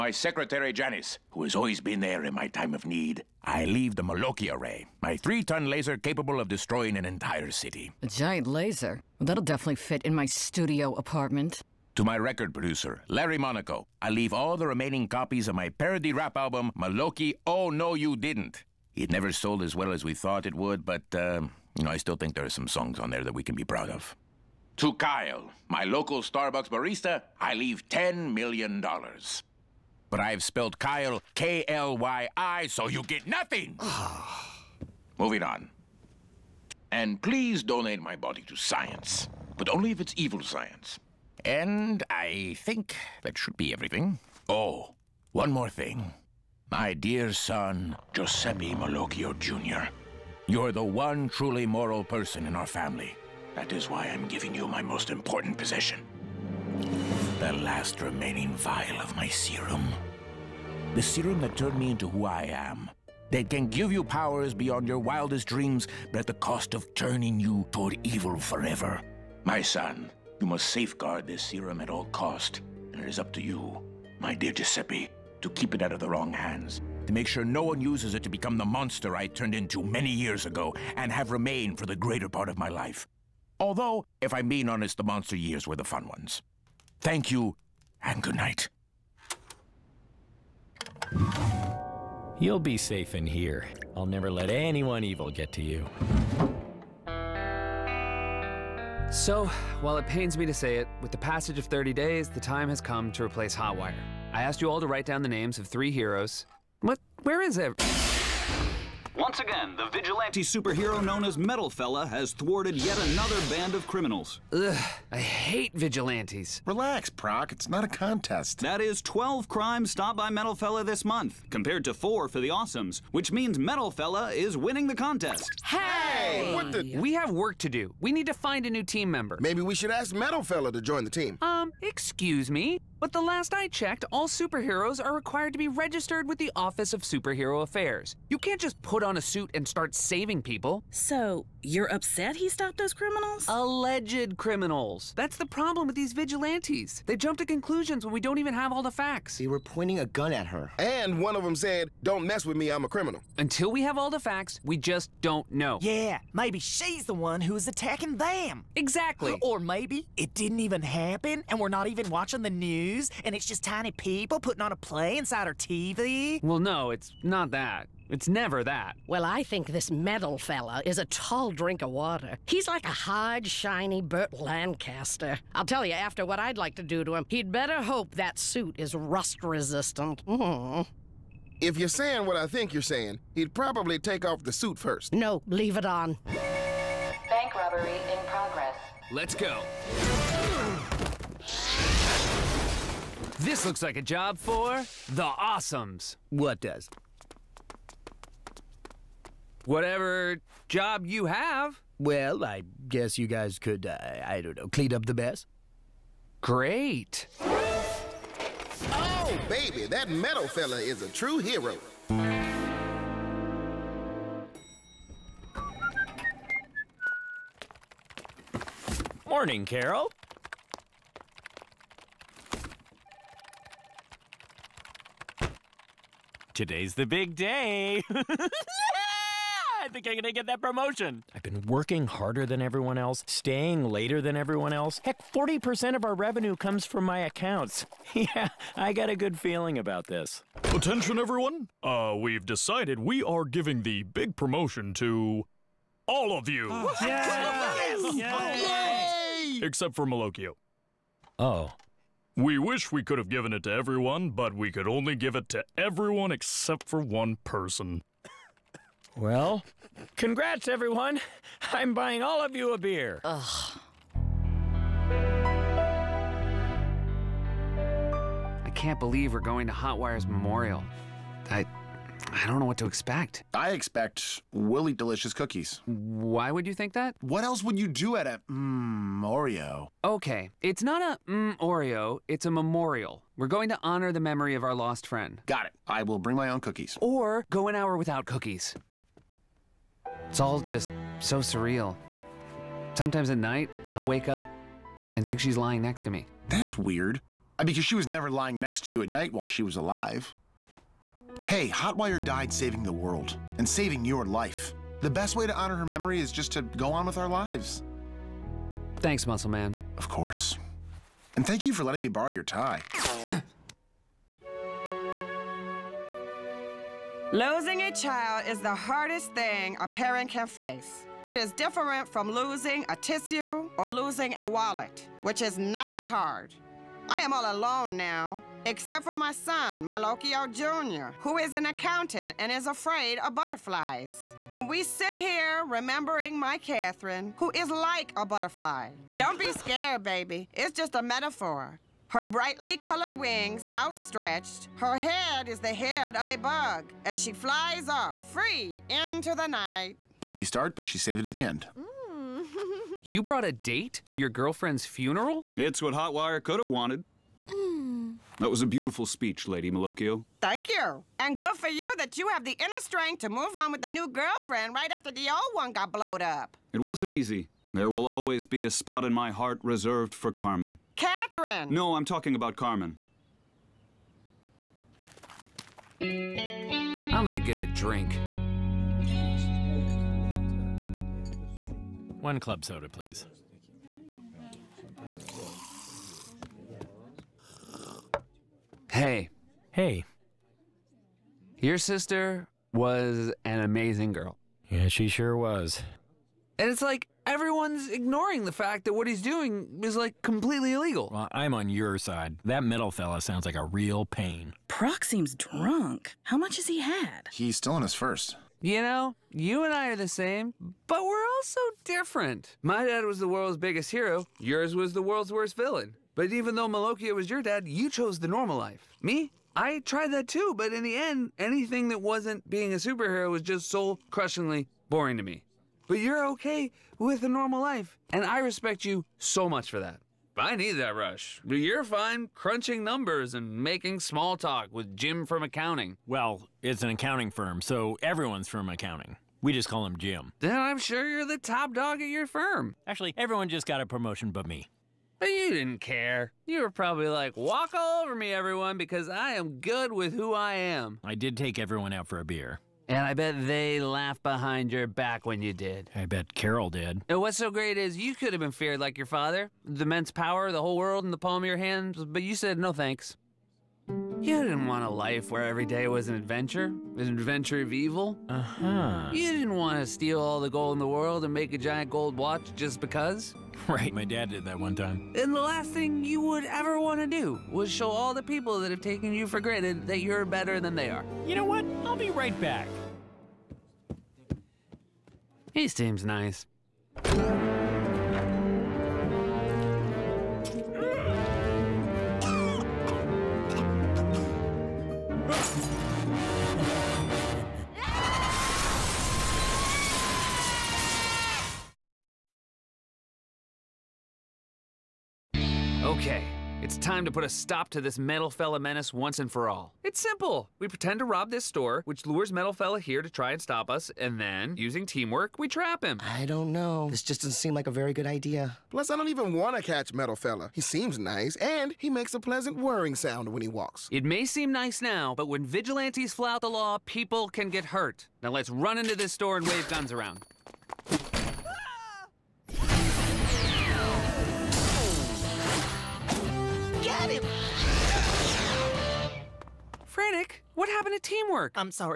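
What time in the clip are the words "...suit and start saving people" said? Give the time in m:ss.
2:19.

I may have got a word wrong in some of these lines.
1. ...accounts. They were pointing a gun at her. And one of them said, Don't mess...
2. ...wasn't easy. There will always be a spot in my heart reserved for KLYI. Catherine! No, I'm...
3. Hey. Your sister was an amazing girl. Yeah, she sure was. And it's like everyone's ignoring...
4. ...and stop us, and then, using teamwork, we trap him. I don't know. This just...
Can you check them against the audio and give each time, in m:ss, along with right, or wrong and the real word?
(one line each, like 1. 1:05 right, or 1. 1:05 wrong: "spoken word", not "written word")
1. 2:28 wrong: "facts", not "accounts"
2. 6:06 wrong: "Carmen", not "KLYI"
3. 6:29 right
4. 8:33 right.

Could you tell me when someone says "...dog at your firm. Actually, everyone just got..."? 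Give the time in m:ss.
7:21.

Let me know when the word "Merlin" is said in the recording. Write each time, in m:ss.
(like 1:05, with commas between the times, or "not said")
not said.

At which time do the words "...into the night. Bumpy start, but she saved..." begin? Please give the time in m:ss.
5:48.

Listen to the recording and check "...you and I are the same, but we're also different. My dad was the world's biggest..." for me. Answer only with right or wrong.
right.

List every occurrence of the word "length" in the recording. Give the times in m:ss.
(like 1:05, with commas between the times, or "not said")
not said.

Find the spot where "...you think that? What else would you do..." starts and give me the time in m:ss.
4:36.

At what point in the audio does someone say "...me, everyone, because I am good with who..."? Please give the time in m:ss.
7:28.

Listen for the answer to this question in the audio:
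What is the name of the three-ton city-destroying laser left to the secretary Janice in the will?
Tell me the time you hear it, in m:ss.
0:04.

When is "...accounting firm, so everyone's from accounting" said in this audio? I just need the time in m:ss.
7:16.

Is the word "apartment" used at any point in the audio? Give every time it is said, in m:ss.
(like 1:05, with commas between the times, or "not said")
0:10.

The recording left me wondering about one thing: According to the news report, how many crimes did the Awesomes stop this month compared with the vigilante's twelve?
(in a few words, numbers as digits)
4.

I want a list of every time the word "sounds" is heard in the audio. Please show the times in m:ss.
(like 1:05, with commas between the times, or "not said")
6:43, 8:42.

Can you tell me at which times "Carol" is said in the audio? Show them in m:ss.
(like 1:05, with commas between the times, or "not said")
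3:39, 7:36.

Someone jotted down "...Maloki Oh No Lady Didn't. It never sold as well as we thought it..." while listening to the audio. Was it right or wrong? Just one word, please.
wrong.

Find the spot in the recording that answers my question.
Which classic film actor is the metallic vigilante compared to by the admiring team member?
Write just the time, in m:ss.
2:54.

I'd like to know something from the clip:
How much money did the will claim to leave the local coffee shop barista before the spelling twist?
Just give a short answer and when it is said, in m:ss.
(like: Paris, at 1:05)
$10 million, at 0:27.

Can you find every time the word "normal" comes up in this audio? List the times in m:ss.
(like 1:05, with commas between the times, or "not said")
6:58, 7:07.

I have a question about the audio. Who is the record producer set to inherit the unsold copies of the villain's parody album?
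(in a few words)
Larry Monaco.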